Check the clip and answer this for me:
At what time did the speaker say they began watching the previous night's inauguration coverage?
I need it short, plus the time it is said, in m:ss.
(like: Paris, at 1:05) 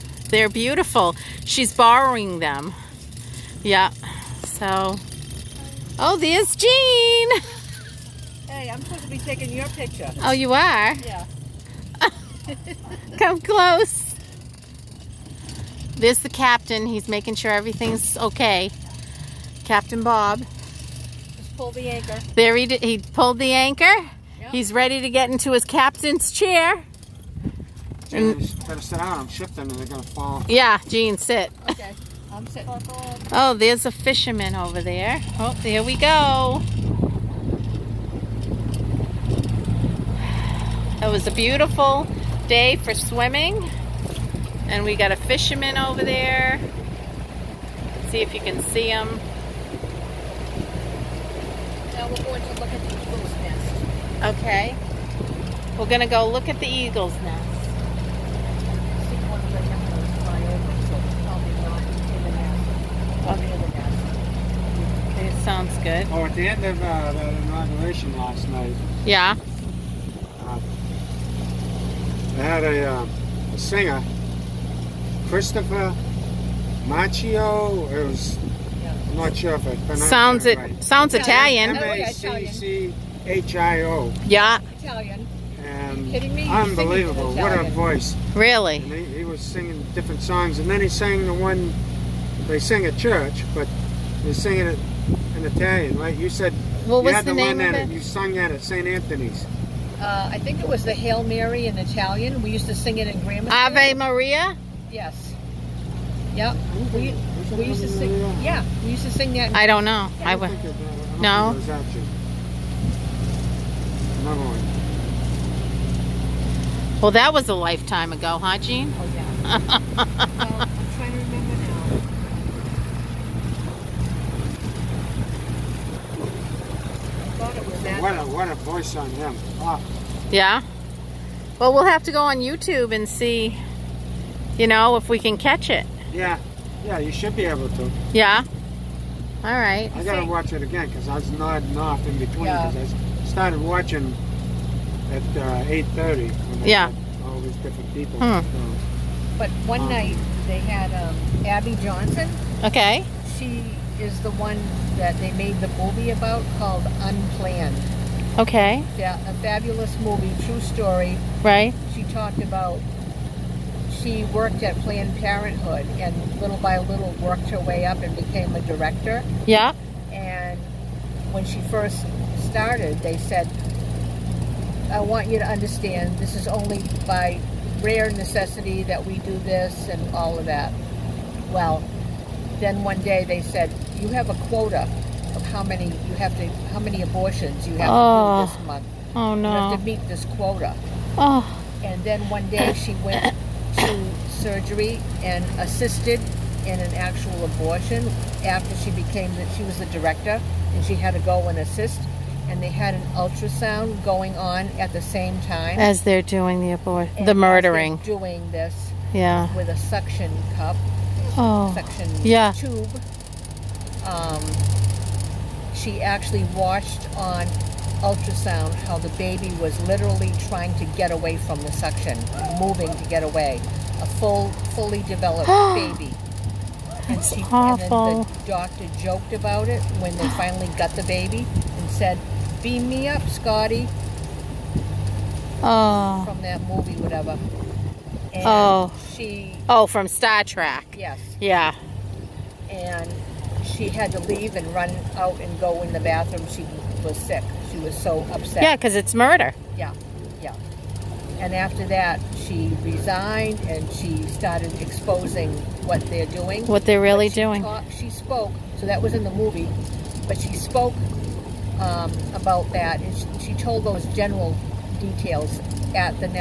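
8:30, at 2:25.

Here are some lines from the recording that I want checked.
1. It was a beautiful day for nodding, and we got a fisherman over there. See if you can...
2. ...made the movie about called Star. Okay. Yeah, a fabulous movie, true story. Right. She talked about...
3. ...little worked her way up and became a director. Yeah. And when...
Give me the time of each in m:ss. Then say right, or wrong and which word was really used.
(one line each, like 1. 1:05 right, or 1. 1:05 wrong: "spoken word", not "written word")
1. 0:40 wrong: "swimming", not "nodding"
2. 2:35 wrong: "Unplanned", not "Star"
3. 2:46 right.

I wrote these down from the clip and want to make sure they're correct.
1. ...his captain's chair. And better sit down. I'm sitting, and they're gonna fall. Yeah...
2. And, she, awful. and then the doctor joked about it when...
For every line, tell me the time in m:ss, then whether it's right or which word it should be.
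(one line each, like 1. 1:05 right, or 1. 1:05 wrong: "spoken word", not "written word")
1. 0:25 wrong: "shifting", not "sitting"
2. 3:47 right.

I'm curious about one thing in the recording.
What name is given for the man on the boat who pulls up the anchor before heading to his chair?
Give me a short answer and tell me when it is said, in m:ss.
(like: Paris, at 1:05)
Captain Bob, at 0:19.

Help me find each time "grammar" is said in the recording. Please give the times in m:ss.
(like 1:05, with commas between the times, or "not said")
1:43.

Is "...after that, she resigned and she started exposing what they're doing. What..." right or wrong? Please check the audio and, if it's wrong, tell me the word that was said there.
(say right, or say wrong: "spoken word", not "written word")
right.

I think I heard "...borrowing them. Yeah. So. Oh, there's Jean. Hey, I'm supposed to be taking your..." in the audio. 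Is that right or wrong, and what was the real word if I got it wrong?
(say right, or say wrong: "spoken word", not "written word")
right.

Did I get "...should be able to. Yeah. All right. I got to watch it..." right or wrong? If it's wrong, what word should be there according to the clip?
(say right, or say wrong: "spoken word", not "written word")
right.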